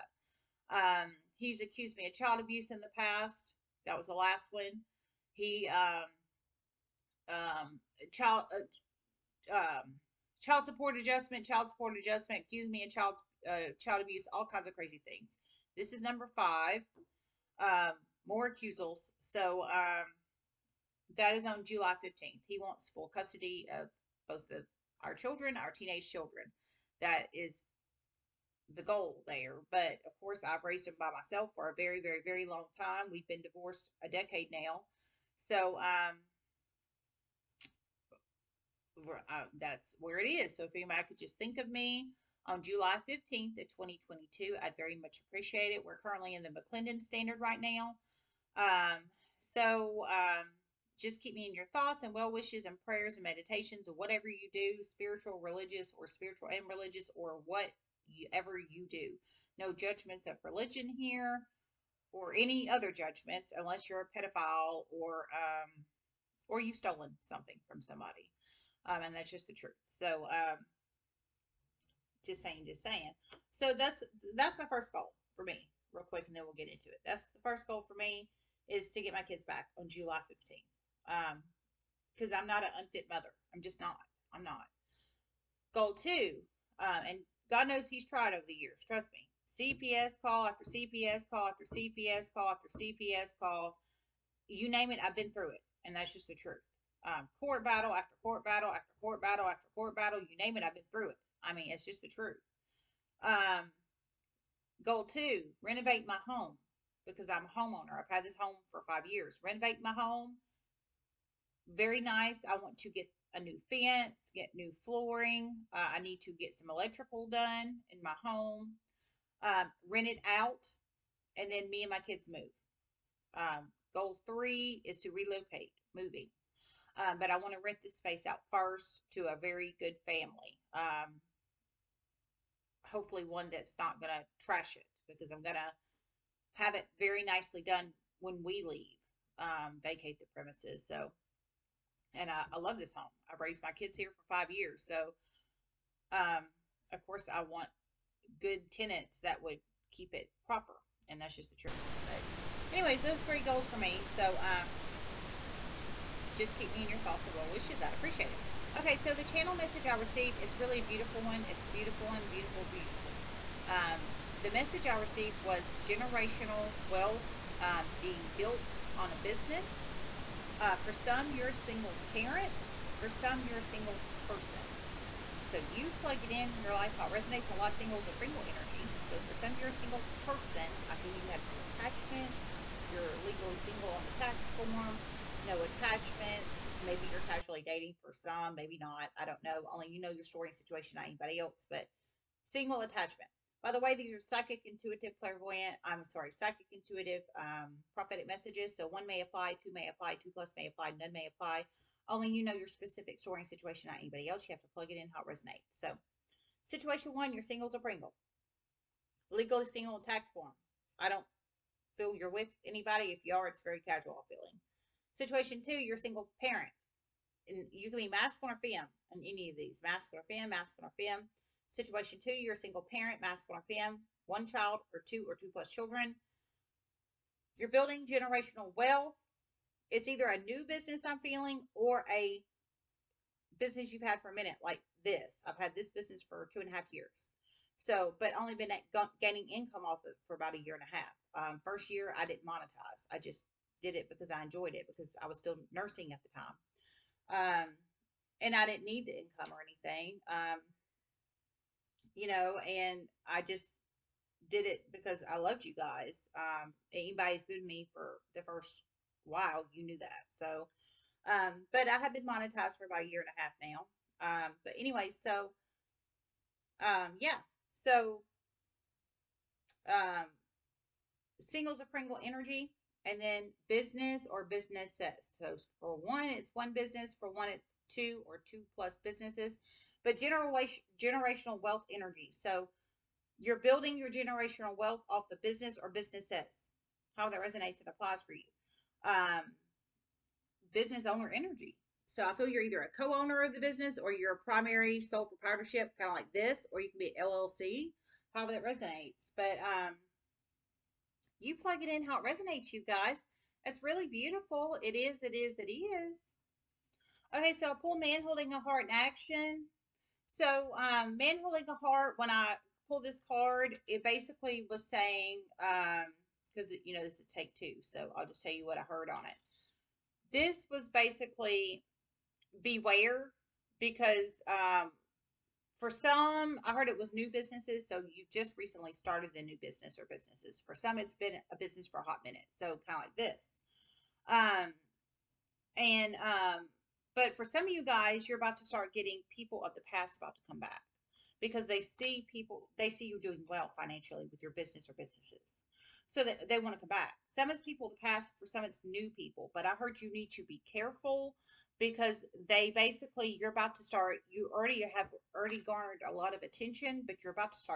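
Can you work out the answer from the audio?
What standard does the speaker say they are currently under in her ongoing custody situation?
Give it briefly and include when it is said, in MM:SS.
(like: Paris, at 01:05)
McClendon standard, at 00:46.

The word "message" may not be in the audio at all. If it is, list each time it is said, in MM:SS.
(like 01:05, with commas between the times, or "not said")
02:39, 02:44, 03:18.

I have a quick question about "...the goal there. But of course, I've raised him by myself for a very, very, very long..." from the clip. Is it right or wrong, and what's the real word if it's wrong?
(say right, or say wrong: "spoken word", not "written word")
right.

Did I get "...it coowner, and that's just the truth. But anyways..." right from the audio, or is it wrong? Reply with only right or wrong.
wrong.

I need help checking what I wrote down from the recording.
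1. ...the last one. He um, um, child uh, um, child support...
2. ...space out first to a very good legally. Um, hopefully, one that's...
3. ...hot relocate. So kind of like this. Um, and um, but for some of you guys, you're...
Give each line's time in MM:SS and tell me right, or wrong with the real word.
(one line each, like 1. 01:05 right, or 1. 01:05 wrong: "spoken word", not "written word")
1. 00:04 right
2. 02:07 wrong: "family", not "legally"
3. 05:32 wrong: "minute", not "relocate".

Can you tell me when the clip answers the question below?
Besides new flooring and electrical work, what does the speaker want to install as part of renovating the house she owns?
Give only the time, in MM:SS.
01:53.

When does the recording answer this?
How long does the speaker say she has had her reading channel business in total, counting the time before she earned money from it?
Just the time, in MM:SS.
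03:56.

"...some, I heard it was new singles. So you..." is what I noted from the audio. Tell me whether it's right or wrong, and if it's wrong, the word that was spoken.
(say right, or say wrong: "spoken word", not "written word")
wrong: "businesses", not "singles".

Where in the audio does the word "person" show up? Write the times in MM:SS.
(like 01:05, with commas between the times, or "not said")
02:54, 03:00.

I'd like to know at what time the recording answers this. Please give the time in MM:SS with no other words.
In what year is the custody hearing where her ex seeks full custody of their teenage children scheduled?
00:43.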